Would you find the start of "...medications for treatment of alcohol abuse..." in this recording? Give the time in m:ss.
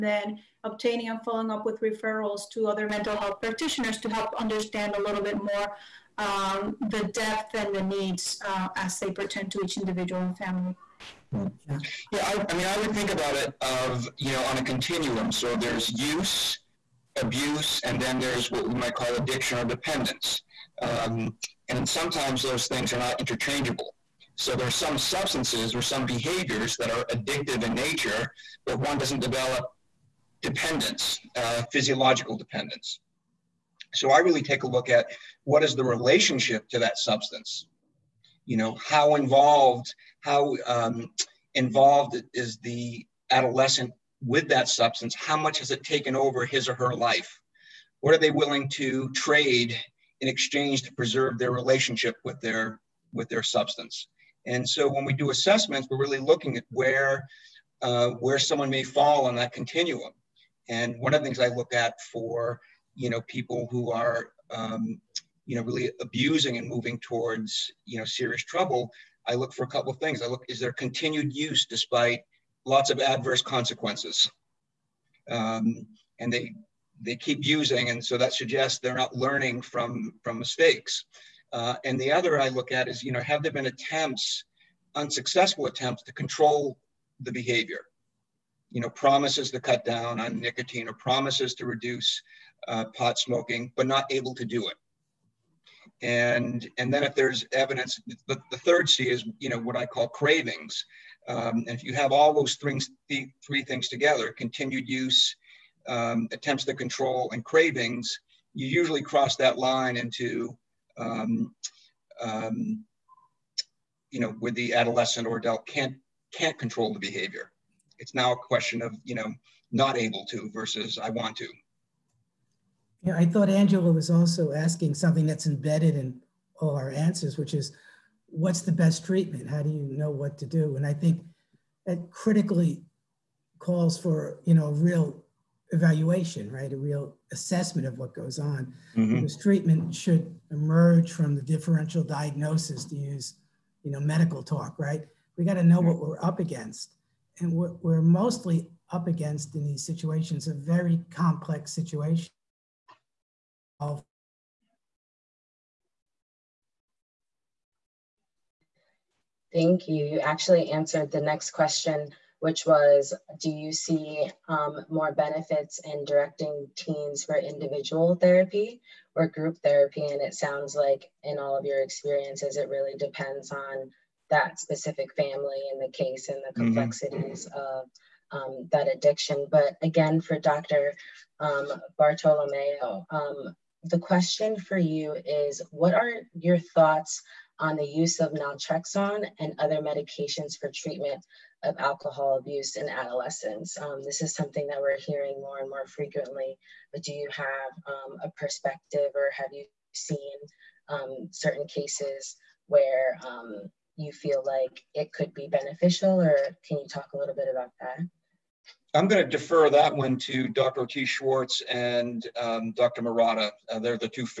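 3:09.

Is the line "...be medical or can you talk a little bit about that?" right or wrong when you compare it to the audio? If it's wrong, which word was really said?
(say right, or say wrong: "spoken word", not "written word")
wrong: "beneficial", not "medical".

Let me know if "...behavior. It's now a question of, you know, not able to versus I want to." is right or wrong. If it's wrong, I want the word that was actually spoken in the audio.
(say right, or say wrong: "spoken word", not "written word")
right.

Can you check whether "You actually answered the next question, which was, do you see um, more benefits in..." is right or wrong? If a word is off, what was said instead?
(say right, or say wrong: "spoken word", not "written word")
right.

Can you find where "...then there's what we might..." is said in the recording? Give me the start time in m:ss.
0:18.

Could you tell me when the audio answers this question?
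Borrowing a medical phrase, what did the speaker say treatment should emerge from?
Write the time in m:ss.
2:21.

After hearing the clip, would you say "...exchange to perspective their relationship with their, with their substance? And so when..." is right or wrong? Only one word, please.
wrong.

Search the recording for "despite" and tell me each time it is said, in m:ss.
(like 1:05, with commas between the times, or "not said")
1:11.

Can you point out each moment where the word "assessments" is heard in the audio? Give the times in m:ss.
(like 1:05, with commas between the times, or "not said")
0:55, 2:17.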